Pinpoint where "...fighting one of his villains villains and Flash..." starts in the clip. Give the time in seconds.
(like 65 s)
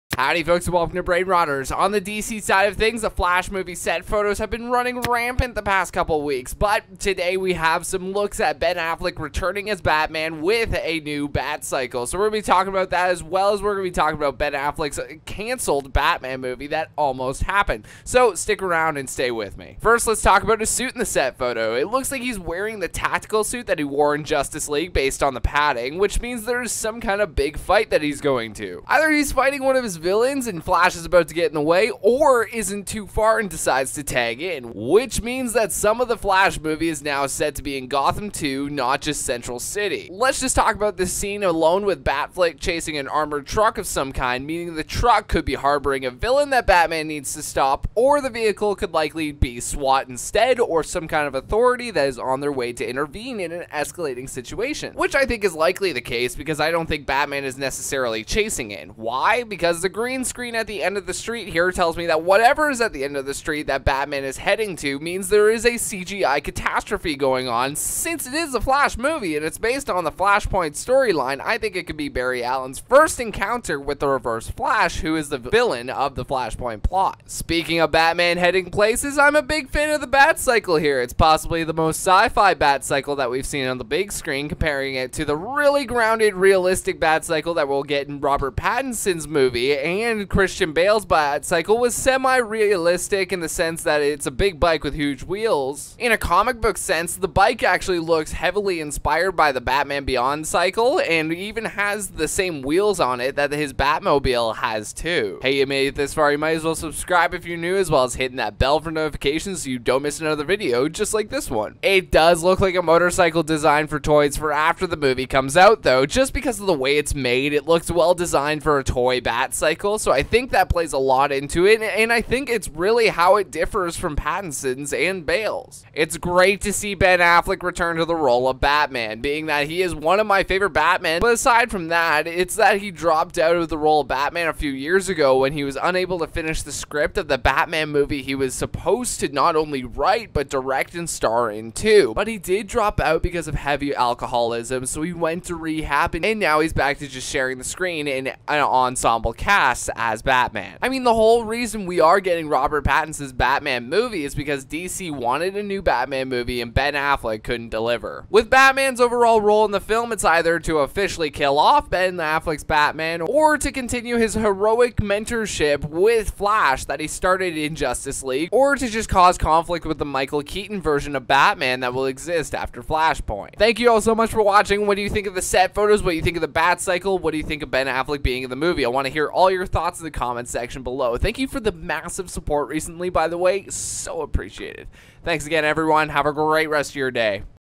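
29 s.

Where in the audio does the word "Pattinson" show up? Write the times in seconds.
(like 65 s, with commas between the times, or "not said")
88 s, 124 s, 152 s.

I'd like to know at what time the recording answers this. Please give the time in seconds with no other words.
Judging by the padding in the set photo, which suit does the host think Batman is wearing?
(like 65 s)
22 s.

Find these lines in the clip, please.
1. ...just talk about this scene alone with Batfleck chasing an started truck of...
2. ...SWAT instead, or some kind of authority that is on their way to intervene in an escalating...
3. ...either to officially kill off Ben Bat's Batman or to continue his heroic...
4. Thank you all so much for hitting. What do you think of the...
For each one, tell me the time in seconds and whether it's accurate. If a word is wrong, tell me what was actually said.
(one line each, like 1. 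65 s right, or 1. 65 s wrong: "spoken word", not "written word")
1. 40 s wrong: "armored", not "started"
2. 49 s right
3. 160 s wrong: "Affleck", not "Bat"
4. 173 s wrong: "watching", not "hitting".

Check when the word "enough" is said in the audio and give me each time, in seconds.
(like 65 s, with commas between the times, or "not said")
not said.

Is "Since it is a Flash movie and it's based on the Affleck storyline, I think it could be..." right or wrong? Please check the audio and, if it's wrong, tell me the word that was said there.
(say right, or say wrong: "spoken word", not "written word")
wrong: "Flashpoint", not "Affleck".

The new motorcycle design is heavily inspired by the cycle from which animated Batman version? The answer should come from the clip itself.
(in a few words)
Batman Beyond.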